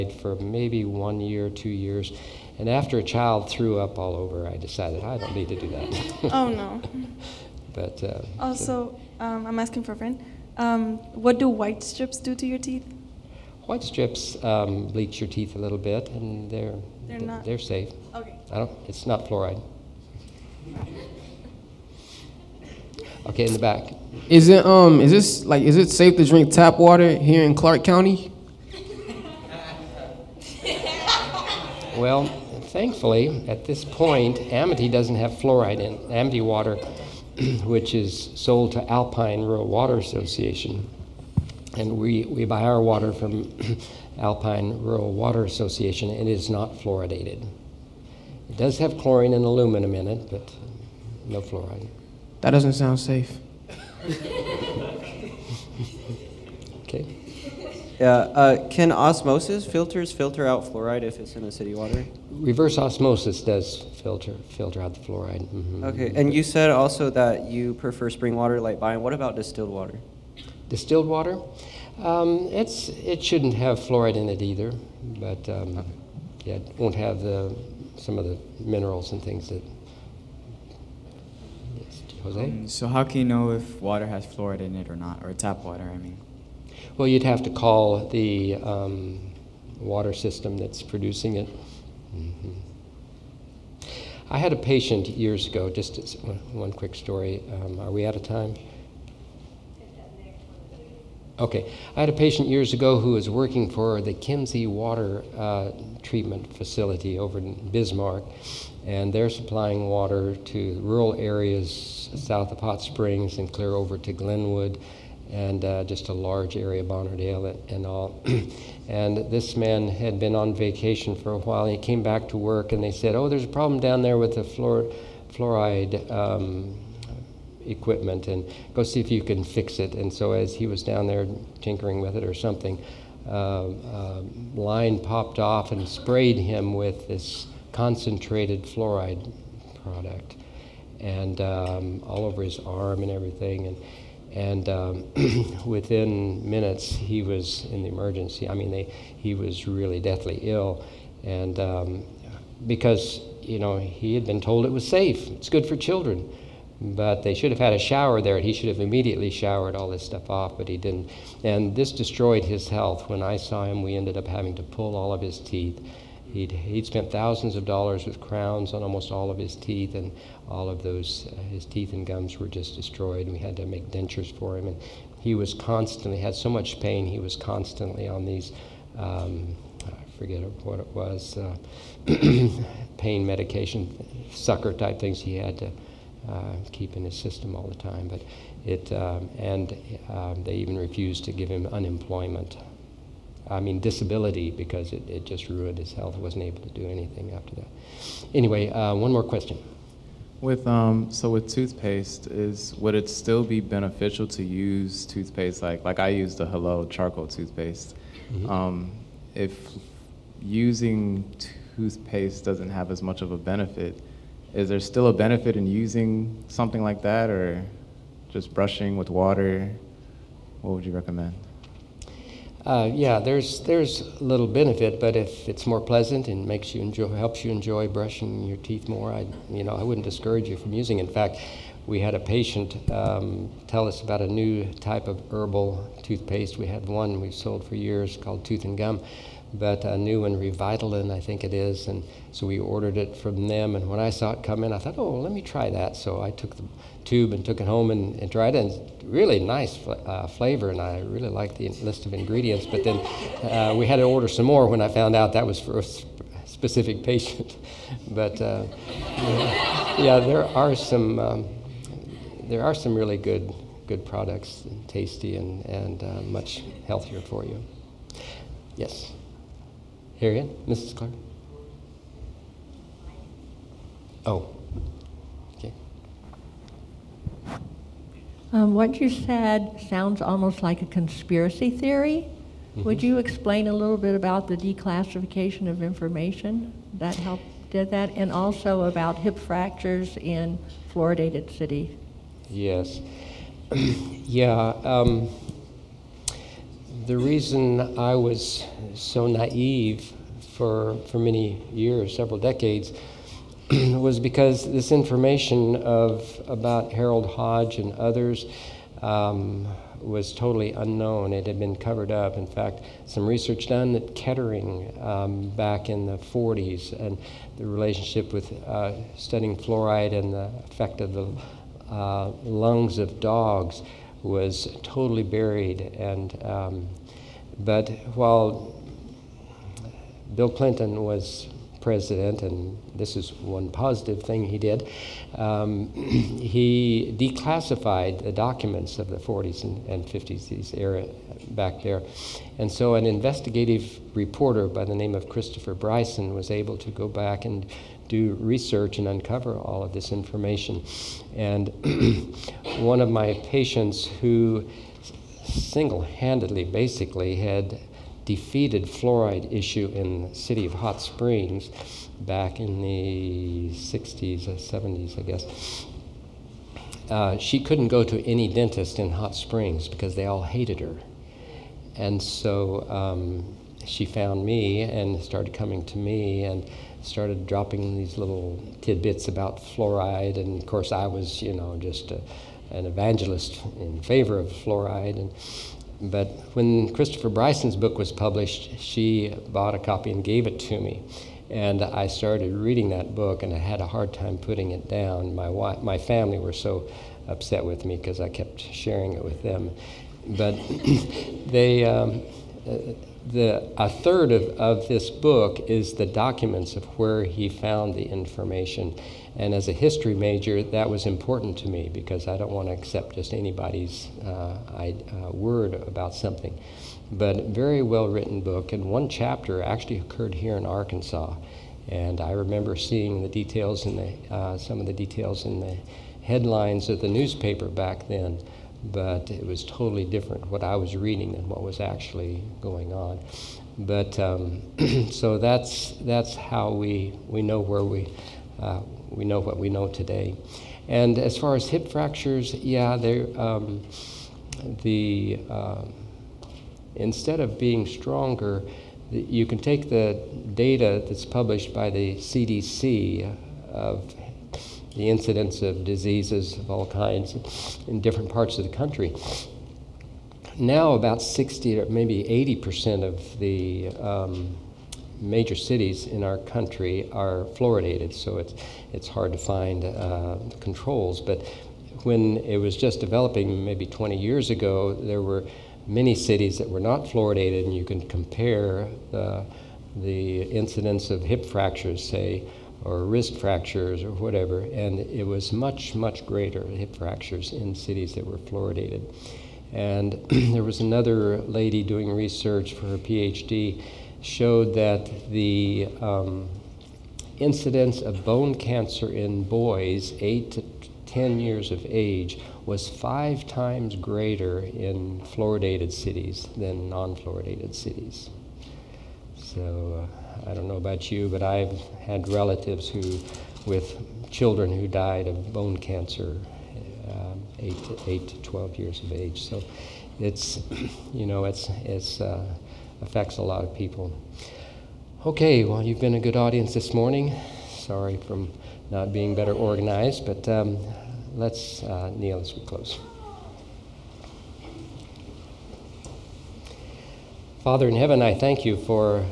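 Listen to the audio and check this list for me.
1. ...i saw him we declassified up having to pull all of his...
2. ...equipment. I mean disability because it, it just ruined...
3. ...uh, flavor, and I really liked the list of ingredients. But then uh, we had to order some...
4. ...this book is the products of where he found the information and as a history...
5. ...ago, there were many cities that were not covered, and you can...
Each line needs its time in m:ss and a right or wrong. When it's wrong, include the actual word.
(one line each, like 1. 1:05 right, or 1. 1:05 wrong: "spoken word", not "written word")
1. 2:43 wrong: "ended", not "declassified"
2. 3:11 wrong: "unemployment", not "equipment"
3. 4:09 right
4. 6:44 wrong: "documents", not "products"
5. 7:54 wrong: "fluoridated", not "covered".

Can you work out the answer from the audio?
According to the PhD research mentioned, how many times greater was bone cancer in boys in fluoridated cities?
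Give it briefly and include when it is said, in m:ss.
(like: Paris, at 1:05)
5, at 8:22.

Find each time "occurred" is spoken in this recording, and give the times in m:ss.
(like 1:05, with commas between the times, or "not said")
6:59.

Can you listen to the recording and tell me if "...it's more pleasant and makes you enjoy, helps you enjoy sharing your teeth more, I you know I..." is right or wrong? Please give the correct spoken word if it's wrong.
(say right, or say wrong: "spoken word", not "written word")
wrong: "brushing", not "sharing".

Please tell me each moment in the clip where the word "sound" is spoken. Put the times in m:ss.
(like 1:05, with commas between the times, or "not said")
0:52, 4:39.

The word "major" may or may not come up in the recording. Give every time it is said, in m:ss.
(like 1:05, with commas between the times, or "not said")
6:50, 7:45.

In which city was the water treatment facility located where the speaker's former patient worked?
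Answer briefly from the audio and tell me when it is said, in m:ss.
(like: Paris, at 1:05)
Bismarck, at 1:47.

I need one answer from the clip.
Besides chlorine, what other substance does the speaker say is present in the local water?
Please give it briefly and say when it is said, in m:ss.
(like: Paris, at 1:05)
aluminum, at 0:49.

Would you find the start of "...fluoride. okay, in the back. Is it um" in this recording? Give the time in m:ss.
0:19.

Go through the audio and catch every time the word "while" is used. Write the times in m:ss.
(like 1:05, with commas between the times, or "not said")
2:01, 5:28.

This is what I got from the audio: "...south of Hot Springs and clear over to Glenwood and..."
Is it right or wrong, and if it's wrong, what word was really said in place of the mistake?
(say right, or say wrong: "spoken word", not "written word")
right.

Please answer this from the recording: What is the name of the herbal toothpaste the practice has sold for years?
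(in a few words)
Tooth and Gum.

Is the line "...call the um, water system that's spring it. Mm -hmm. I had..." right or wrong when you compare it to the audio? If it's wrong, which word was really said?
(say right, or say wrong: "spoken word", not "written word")
wrong: "producing", not "spring".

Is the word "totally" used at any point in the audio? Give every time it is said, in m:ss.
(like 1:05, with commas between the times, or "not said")
5:10, 5:24, 7:09.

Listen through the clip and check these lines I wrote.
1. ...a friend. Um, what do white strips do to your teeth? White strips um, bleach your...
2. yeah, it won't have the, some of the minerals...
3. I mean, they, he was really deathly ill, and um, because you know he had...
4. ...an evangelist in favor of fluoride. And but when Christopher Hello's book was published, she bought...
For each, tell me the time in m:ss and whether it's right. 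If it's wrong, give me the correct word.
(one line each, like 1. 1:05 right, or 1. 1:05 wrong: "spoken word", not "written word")
1. 0:09 right
2. 1:16 right
3. 2:28 right
4. 6:22 wrong: "Bryson", not "Hello".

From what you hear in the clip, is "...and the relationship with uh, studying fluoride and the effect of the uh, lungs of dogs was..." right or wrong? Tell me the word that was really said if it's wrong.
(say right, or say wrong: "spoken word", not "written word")
right.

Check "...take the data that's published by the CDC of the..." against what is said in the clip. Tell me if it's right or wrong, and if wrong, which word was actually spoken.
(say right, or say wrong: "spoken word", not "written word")
right.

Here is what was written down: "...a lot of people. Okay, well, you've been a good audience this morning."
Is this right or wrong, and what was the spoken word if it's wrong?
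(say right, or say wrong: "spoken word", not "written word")
right.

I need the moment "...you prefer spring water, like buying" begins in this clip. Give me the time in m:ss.
1:07.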